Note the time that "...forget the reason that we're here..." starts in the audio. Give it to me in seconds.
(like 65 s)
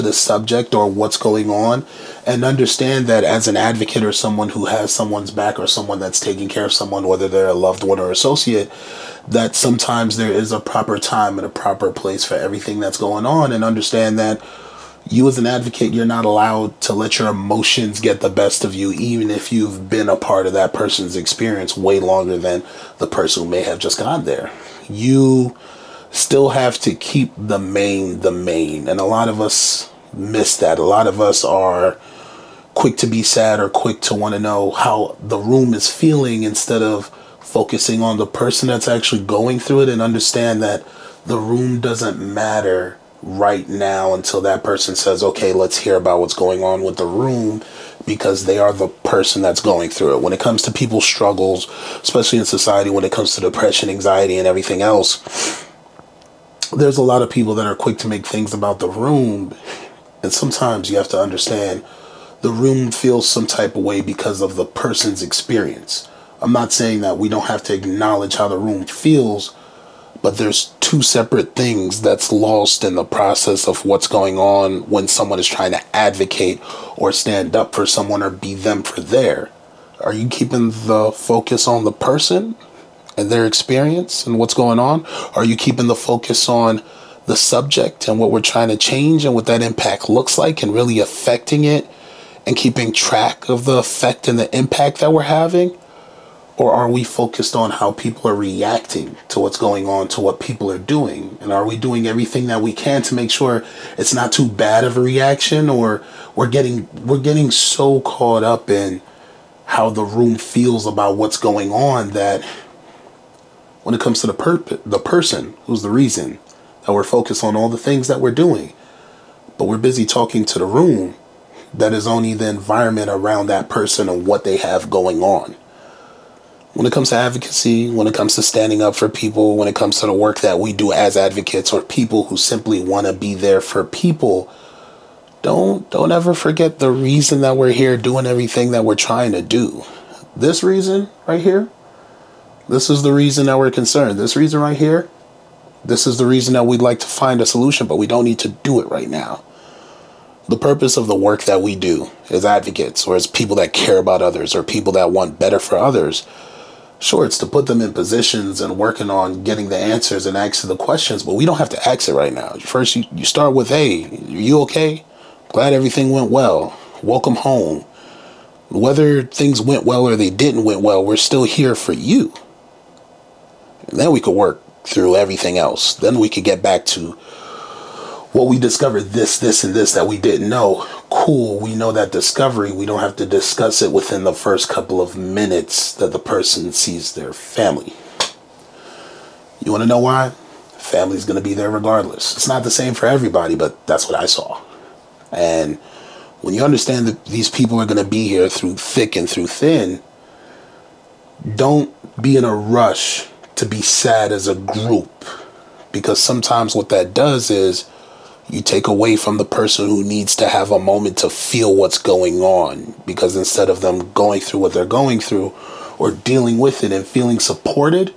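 136 s.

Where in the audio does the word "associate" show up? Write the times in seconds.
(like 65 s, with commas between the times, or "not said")
8 s.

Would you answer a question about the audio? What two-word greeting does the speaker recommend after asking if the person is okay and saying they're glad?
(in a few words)
Welcome home.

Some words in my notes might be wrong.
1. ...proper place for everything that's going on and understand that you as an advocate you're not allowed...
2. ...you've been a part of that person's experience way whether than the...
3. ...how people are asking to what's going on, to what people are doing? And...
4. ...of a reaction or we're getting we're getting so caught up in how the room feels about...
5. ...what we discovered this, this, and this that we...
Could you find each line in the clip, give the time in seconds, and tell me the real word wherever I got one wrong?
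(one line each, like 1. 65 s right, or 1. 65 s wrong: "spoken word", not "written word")
1. 11 s right
2. 19 s wrong: "longer", not "whether"
3. 97 s wrong: "reacting", not "asking"
4. 104 s right
5. 178 s right.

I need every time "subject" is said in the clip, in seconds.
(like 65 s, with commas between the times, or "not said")
0 s, 87 s.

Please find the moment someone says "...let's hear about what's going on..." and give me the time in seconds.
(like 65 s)
45 s.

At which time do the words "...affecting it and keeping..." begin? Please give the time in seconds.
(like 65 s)
90 s.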